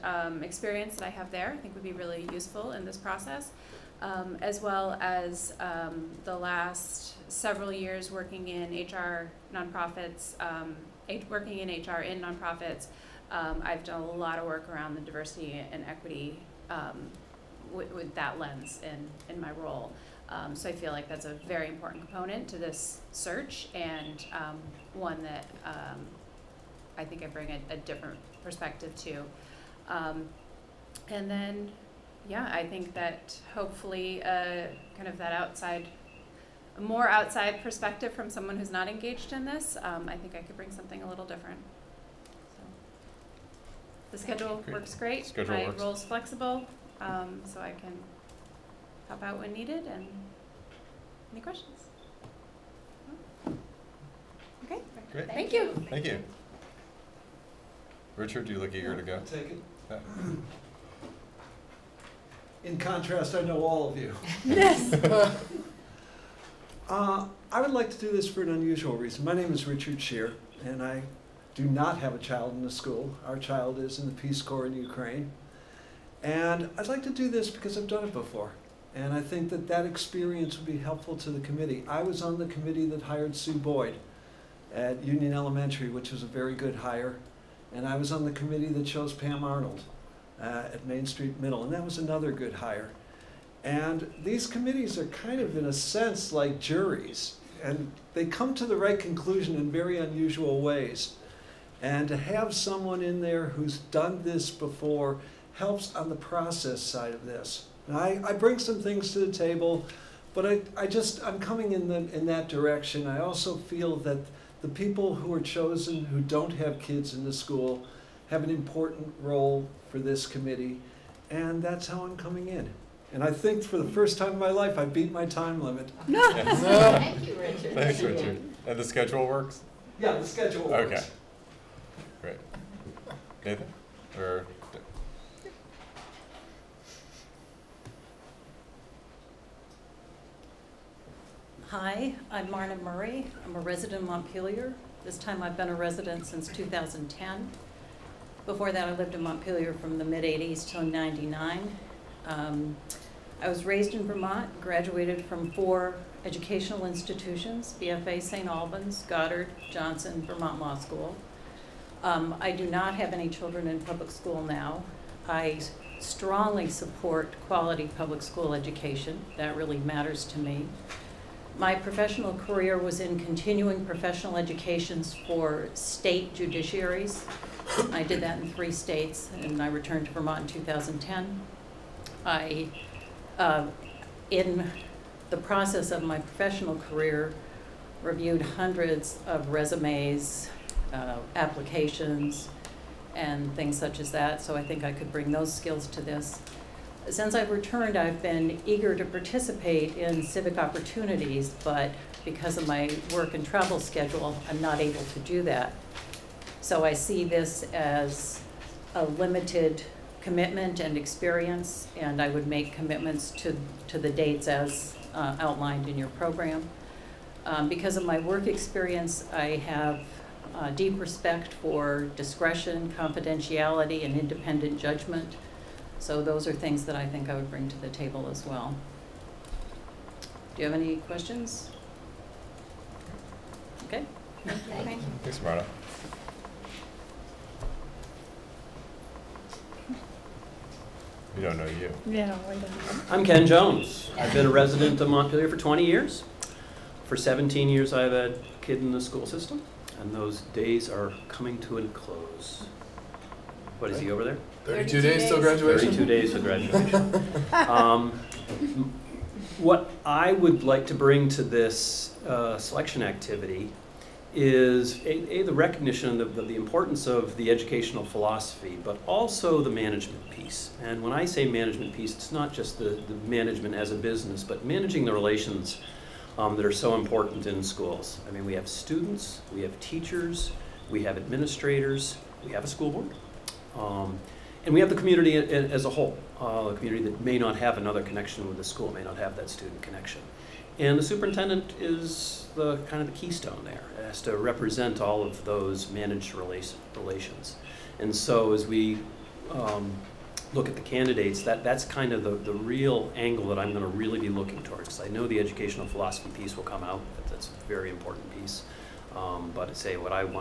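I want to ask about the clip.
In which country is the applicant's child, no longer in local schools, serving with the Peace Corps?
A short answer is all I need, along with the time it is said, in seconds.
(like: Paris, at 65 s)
Ukraine, at 74 s.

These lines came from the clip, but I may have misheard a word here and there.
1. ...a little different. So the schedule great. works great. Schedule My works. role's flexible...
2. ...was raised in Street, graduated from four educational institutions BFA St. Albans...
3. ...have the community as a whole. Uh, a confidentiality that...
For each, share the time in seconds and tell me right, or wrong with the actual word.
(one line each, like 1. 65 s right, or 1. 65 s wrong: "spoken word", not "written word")
1. 41 s right
2. 153 s wrong: "Vermont", not "Street"
3. 284 s wrong: "community", not "confidentiality".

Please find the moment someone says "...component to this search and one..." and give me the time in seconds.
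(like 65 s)
22 s.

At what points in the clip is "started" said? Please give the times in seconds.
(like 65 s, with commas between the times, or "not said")
not said.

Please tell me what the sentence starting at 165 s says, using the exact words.
I strongly support quality public school education.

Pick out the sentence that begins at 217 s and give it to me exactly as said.
Um, because of my work experience, I have uh, deep respect for discretion, confidentiality, and independent judgment.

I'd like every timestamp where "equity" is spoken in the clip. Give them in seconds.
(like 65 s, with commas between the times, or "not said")
15 s.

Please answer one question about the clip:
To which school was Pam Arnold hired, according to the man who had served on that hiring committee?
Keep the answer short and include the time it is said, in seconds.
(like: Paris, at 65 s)
Main Street Middle, at 90 s.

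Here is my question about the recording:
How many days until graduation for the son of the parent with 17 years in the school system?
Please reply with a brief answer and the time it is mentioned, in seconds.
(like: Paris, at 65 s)
32, at 255 s.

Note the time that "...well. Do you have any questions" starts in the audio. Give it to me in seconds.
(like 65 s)
228 s.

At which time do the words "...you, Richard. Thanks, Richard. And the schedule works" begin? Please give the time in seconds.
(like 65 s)
127 s.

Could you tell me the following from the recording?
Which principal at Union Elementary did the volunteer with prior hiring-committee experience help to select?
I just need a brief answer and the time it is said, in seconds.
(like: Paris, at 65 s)
Sue Boyd, at 83 s.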